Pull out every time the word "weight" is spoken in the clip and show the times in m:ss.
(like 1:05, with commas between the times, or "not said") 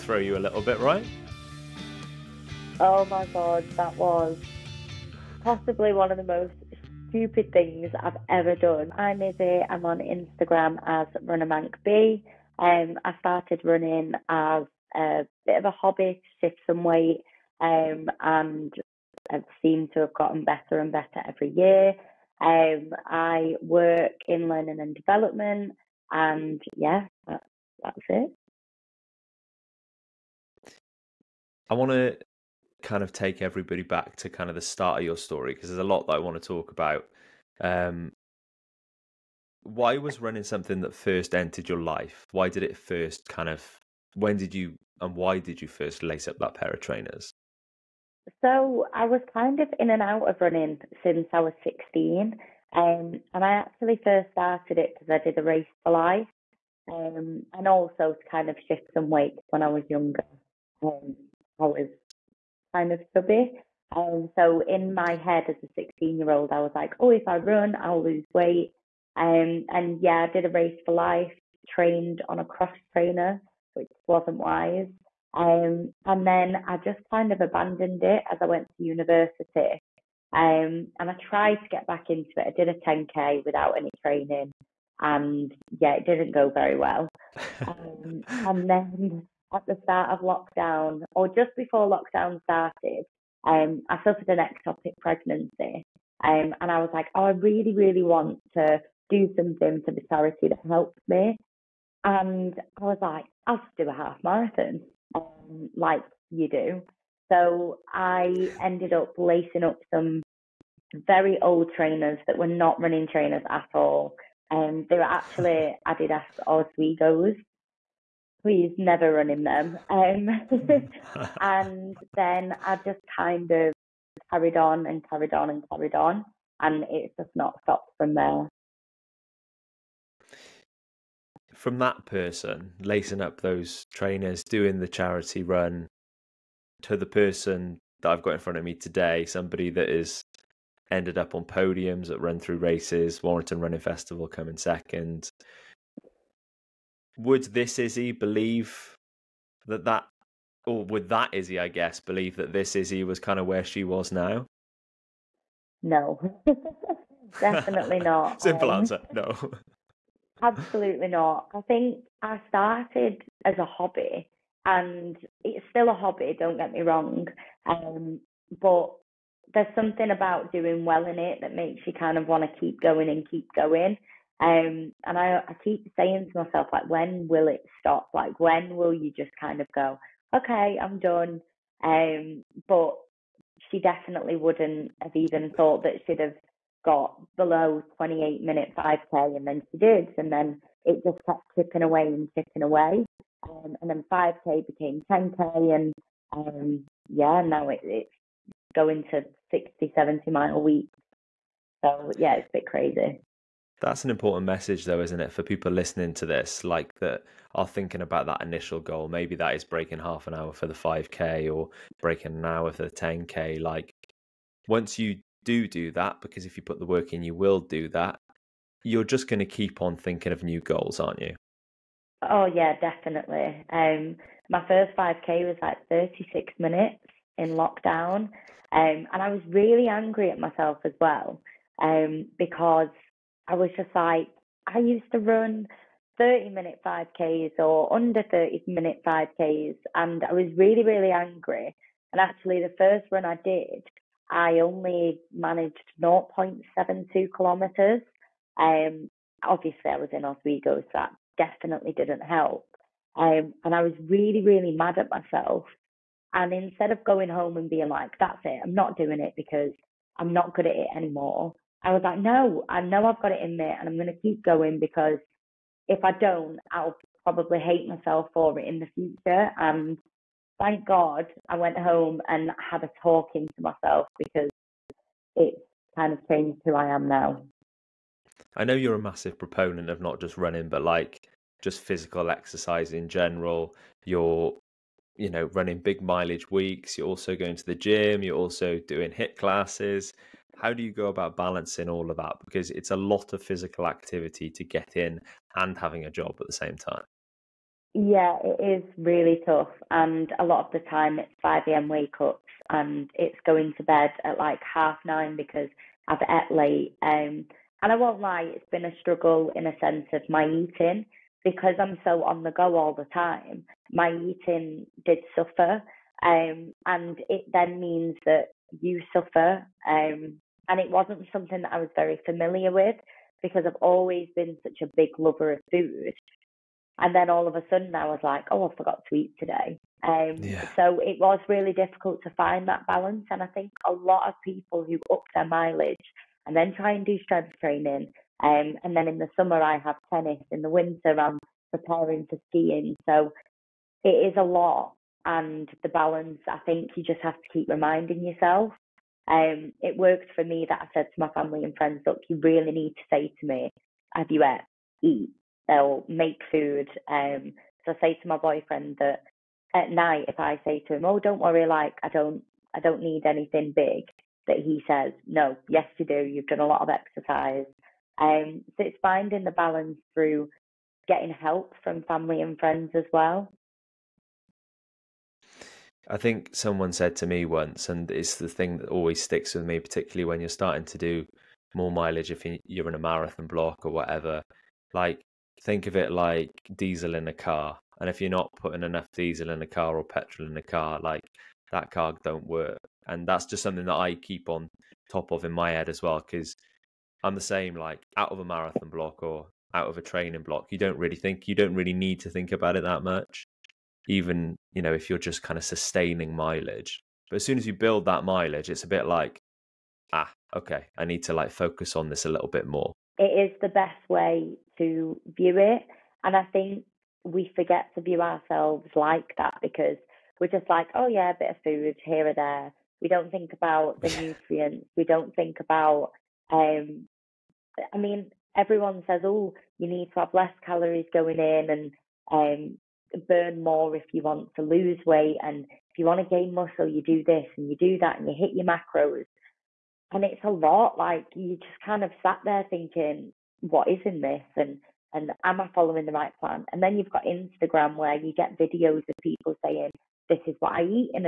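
0:16, 0:59, 1:08, 7:15.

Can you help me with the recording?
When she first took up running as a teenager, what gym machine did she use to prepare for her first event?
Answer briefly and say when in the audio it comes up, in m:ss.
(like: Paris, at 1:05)
cross trainer, at 1:12.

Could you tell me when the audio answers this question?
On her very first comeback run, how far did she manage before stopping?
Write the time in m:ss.
4:05.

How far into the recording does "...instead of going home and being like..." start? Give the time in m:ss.
4:16.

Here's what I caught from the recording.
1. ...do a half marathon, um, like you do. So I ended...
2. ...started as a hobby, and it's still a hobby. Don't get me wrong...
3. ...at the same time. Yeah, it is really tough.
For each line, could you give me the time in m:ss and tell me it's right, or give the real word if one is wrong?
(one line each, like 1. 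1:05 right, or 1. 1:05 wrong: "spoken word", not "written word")
1. 1:43 right
2. 2:42 right
3. 4:56 right.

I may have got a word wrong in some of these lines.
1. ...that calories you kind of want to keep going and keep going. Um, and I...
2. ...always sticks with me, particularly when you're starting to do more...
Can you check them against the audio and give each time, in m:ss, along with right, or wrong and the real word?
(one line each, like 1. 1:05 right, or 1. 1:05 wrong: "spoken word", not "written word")
1. 2:51 wrong: "makes", not "calories"
2. 6:18 right.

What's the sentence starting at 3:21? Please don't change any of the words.
So yeah, it's a bit crazy.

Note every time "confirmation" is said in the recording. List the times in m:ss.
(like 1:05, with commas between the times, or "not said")
not said.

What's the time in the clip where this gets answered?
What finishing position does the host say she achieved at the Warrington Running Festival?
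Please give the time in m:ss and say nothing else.
2:24.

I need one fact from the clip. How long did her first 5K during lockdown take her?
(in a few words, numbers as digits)
36 minutes.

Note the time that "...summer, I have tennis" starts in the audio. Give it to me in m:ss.
5:39.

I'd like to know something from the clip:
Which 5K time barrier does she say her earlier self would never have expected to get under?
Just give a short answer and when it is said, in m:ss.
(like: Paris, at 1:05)
28 minutes, at 3:07.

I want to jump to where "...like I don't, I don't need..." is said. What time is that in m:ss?
6:01.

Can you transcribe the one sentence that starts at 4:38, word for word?
I know you're a massive proponent of not just running, but like just physical exercise in general.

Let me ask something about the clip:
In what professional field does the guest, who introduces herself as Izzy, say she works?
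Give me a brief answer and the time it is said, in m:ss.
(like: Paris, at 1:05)
learning and development, at 0:24.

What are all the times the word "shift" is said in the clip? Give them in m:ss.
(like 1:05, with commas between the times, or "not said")
0:16, 0:58.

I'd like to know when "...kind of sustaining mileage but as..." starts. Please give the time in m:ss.
6:45.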